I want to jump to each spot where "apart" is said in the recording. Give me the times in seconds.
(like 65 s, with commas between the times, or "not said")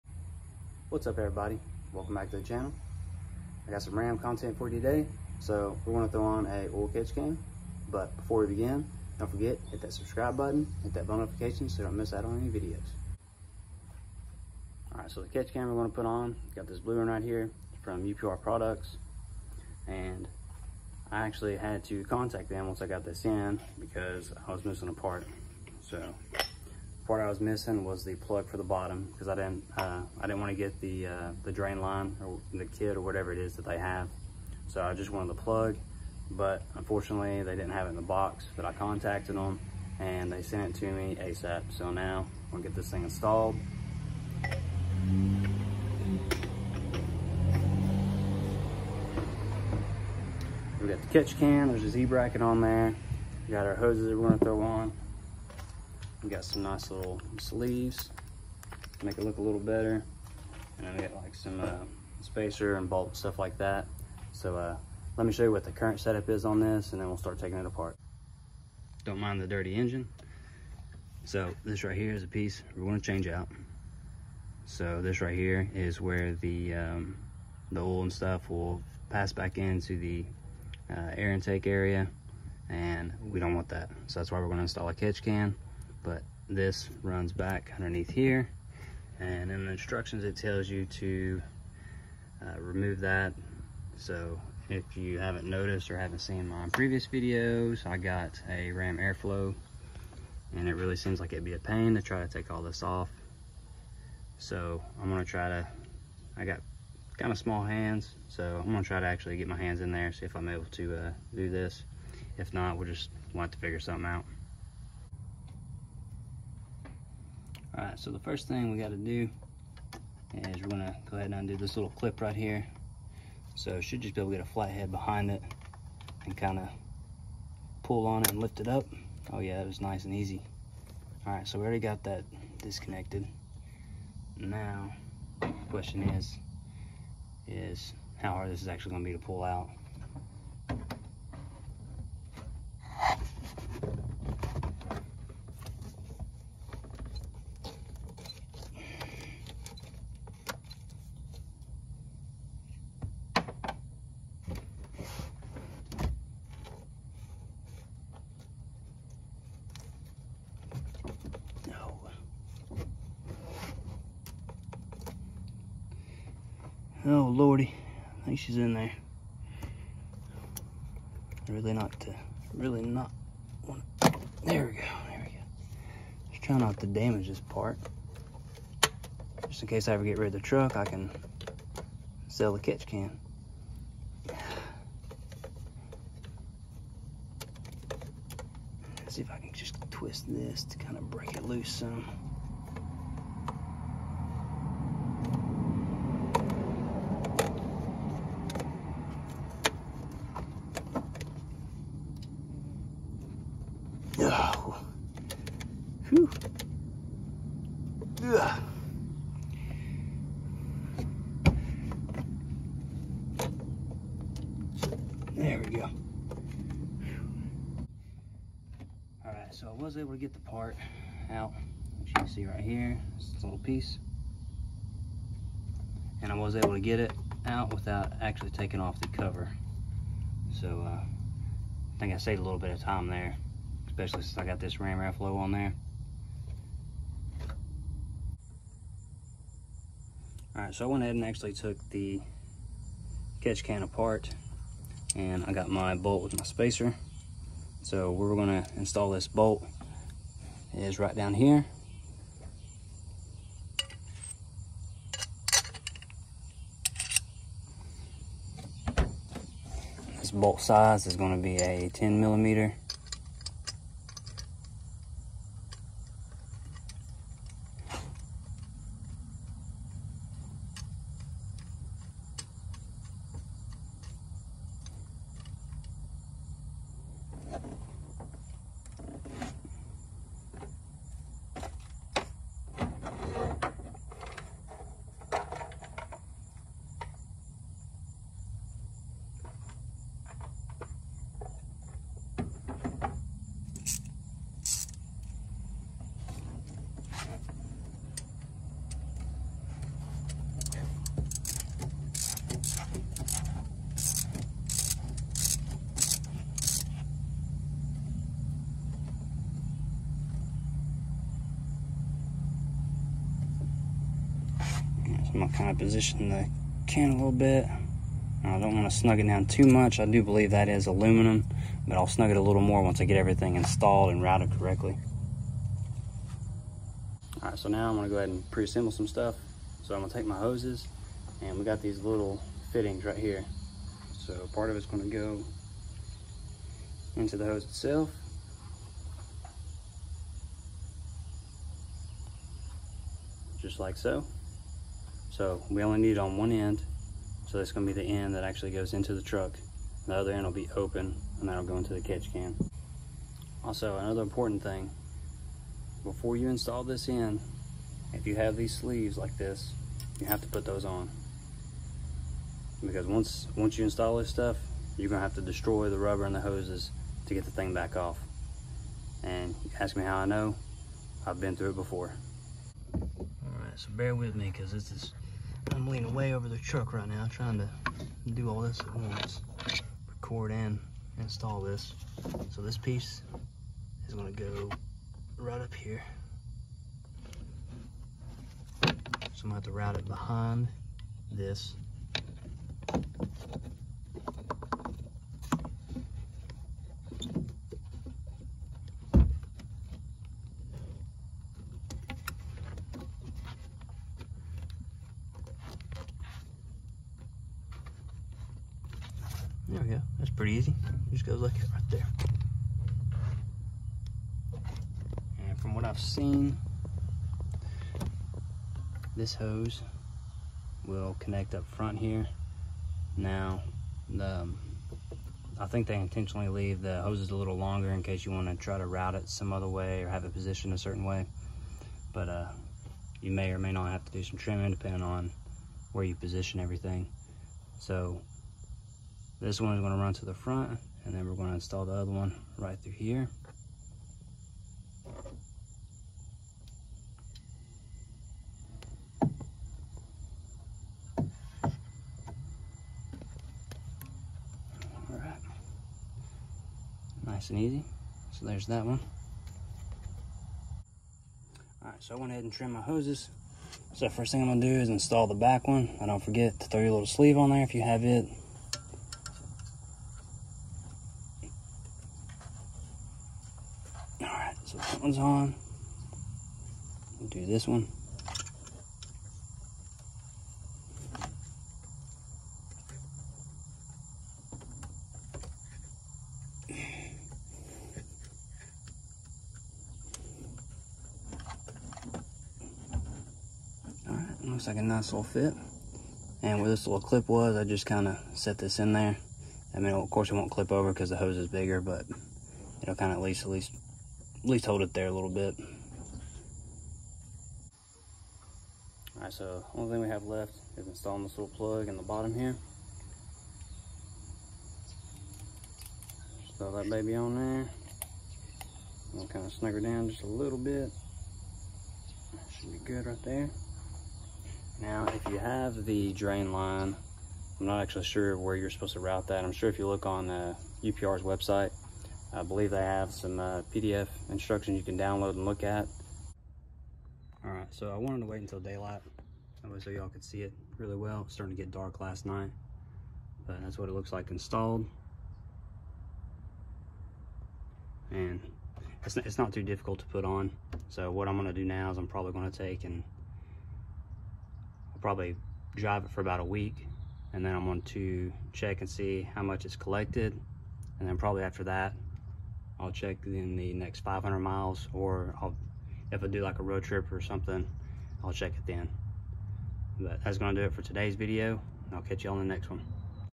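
67 s, 243 s.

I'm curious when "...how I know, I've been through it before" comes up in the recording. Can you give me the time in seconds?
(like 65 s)
370 s.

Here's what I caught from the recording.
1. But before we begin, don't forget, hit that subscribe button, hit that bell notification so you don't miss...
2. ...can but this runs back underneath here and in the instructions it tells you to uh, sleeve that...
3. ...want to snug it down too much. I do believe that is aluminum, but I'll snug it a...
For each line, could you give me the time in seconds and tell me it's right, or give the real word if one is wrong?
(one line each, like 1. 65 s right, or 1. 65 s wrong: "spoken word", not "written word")
1. 7 s right
2. 85 s wrong: "remove", not "sleeve"
3. 318 s right.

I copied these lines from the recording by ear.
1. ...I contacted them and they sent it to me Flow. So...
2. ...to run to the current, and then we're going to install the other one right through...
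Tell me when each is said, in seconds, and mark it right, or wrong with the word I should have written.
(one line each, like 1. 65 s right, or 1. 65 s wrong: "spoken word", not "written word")
1. 38 s wrong: "ASAP", not "Flow"
2. 439 s wrong: "front", not "current".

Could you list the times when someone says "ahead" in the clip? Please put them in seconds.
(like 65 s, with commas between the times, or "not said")
121 s, 241 s, 328 s, 462 s.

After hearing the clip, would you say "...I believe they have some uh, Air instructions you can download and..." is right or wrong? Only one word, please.
wrong.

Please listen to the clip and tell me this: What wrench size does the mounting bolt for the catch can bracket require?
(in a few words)
10 millimeter.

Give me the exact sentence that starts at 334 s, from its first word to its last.
So part of it's gonna go into the hose itself.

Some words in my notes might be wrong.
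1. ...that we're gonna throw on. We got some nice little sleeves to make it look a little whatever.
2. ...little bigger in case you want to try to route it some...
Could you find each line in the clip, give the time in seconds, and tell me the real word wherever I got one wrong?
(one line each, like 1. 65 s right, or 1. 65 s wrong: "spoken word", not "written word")
1. 54 s wrong: "better", not "whatever"
2. 427 s wrong: "longer", not "bigger".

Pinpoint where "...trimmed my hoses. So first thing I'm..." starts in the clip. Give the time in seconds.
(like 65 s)
462 s.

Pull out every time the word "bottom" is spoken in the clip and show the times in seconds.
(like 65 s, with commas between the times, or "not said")
28 s, 512 s.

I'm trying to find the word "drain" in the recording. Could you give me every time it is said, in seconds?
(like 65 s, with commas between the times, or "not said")
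31 s, 526 s.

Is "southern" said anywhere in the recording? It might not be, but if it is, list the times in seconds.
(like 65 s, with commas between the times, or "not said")
not said.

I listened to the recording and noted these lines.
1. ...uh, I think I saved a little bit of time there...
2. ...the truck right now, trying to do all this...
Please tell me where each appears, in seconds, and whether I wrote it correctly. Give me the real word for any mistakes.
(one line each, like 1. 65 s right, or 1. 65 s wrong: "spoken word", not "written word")
1. 230 s right
2. 376 s right.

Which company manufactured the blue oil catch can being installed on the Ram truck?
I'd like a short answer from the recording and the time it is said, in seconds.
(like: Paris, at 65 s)
UPR Products, at 18 s.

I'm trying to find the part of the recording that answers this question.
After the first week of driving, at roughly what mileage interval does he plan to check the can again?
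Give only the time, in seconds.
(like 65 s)
563 s.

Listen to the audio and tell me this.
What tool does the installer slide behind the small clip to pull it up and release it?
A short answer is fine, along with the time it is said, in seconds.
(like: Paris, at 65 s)
A flathead, at 124 s.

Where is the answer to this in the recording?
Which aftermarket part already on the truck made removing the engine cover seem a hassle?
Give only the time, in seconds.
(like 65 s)
98 s.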